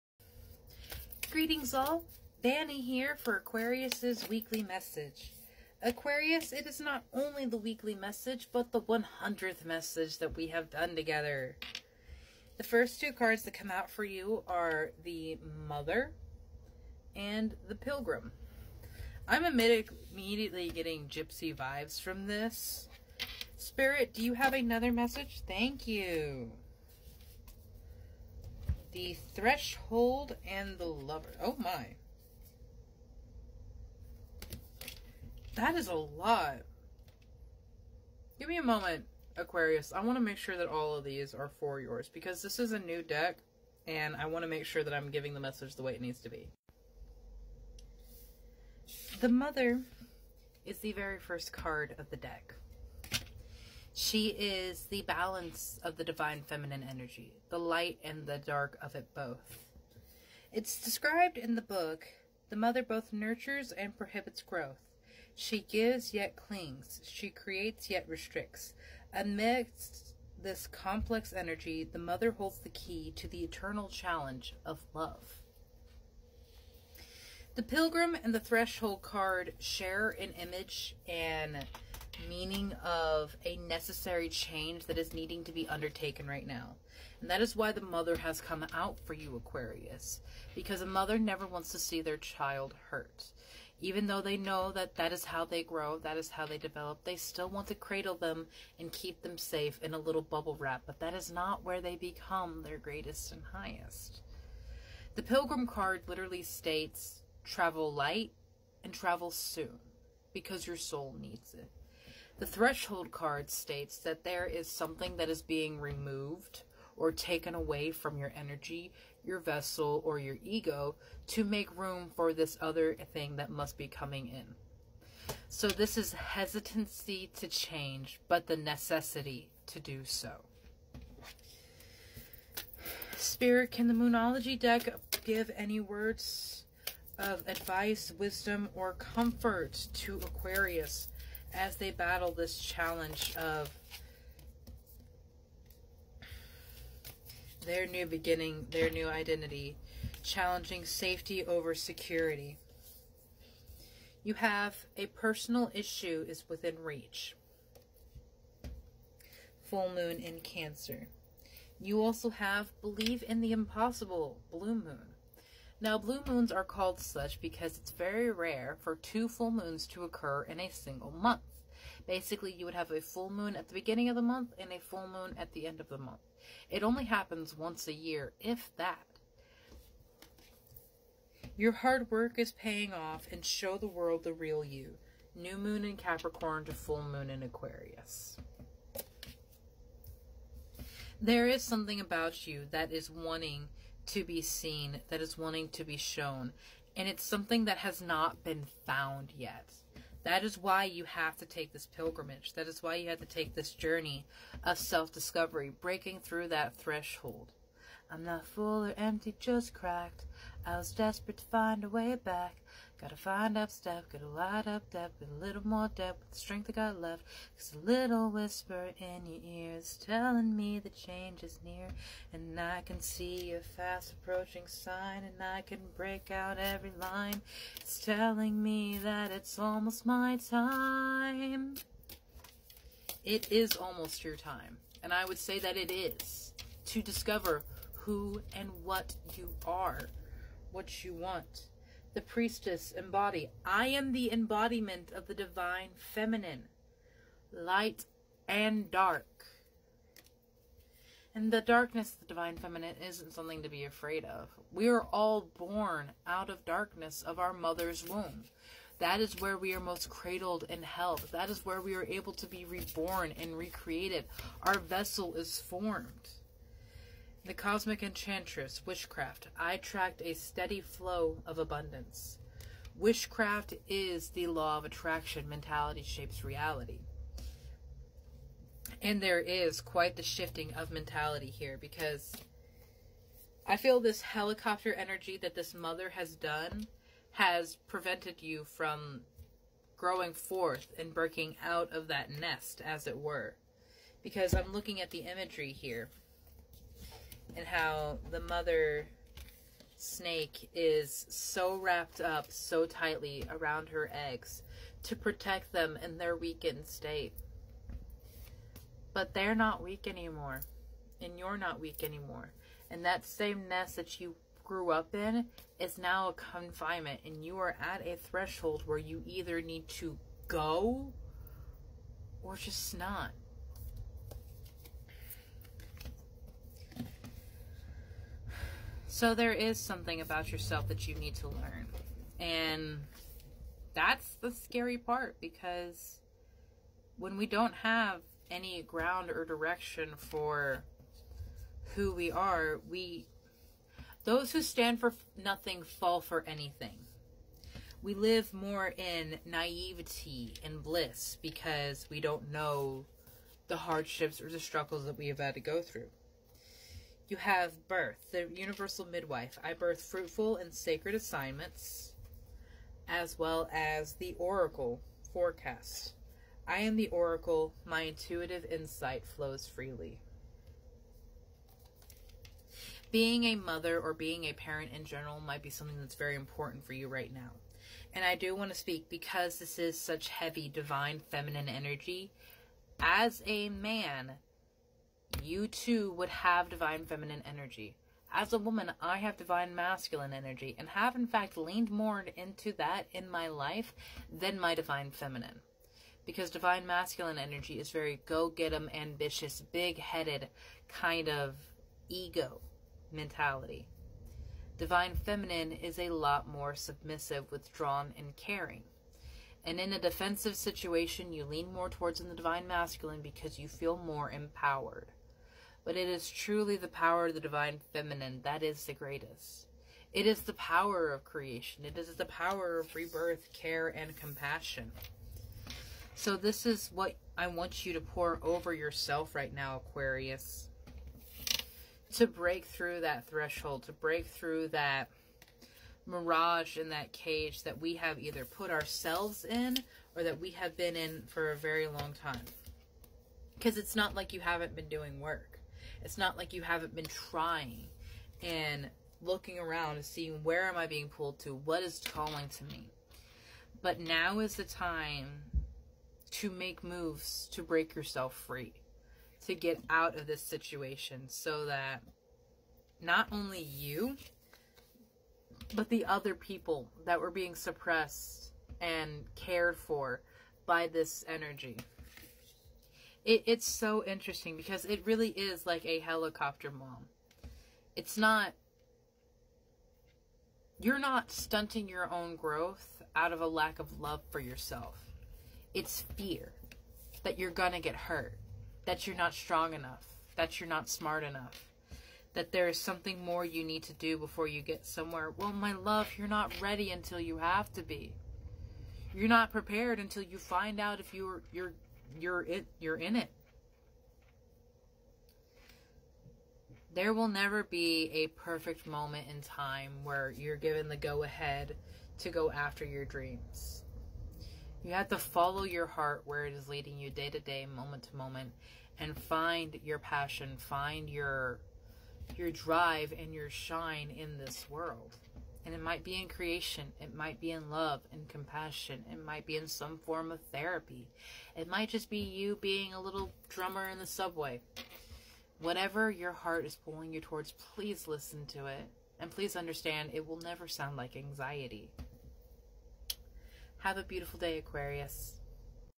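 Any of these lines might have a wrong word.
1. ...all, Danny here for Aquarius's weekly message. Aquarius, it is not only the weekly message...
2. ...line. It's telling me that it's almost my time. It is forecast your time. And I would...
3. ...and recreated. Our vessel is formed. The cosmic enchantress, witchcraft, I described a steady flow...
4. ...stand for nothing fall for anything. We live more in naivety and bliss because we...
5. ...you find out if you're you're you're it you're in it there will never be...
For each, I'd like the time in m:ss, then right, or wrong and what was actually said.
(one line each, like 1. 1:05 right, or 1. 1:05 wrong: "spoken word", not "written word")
1. 0:01 right
2. 3:46 wrong: "almost", not "forecast"
3. 4:23 wrong: "tracked", not "described"
4. 5:44 right
5. 8:20 right.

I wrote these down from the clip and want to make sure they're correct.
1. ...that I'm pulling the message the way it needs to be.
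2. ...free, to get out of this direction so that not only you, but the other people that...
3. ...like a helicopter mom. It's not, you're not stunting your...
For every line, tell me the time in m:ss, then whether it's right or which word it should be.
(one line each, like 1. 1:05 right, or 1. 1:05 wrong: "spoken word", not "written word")
1. 0:44 wrong: "giving", not "pulling"
2. 7:38 wrong: "situation", not "direction"
3. 7:55 right.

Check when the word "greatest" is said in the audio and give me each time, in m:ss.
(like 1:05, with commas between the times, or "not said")
1:42, 6:58.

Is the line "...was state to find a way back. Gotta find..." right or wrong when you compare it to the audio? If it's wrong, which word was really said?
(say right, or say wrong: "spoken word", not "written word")
wrong: "desperate", not "state".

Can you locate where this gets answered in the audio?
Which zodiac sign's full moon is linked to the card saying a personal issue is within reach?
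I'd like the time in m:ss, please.
2:40.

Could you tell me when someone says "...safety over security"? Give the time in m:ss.
2:30.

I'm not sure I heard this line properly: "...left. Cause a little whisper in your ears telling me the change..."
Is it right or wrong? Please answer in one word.
right.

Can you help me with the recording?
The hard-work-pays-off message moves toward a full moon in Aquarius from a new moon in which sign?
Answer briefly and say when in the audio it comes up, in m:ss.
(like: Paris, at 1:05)
Capricorn, at 3:05.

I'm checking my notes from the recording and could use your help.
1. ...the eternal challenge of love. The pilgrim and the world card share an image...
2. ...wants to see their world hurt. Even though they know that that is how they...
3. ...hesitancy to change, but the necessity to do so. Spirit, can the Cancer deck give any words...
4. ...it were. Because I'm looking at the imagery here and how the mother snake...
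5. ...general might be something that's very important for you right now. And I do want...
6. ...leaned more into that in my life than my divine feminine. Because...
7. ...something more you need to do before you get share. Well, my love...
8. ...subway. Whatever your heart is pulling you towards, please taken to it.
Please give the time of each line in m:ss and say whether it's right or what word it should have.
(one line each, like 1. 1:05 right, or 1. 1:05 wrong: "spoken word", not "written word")
1. 1:13 wrong: "threshold", not "world"
2. 1:31 wrong: "child", not "world"
3. 2:06 wrong: "Moonology", not "Cancer"
4. 4:53 right
5. 6:15 right
6. 6:31 right
7. 8:12 wrong: "somewhere", not "share"
8. 8:54 wrong: "listen", not "taken".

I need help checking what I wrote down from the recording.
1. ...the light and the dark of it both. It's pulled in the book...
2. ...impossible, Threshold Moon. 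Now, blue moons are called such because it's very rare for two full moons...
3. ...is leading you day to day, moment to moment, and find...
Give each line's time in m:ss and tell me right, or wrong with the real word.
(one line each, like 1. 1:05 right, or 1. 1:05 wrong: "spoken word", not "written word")
1. 0:57 wrong: "described", not "pulled"
2. 2:43 wrong: "Blue", not "Threshold"
3. 8:36 right.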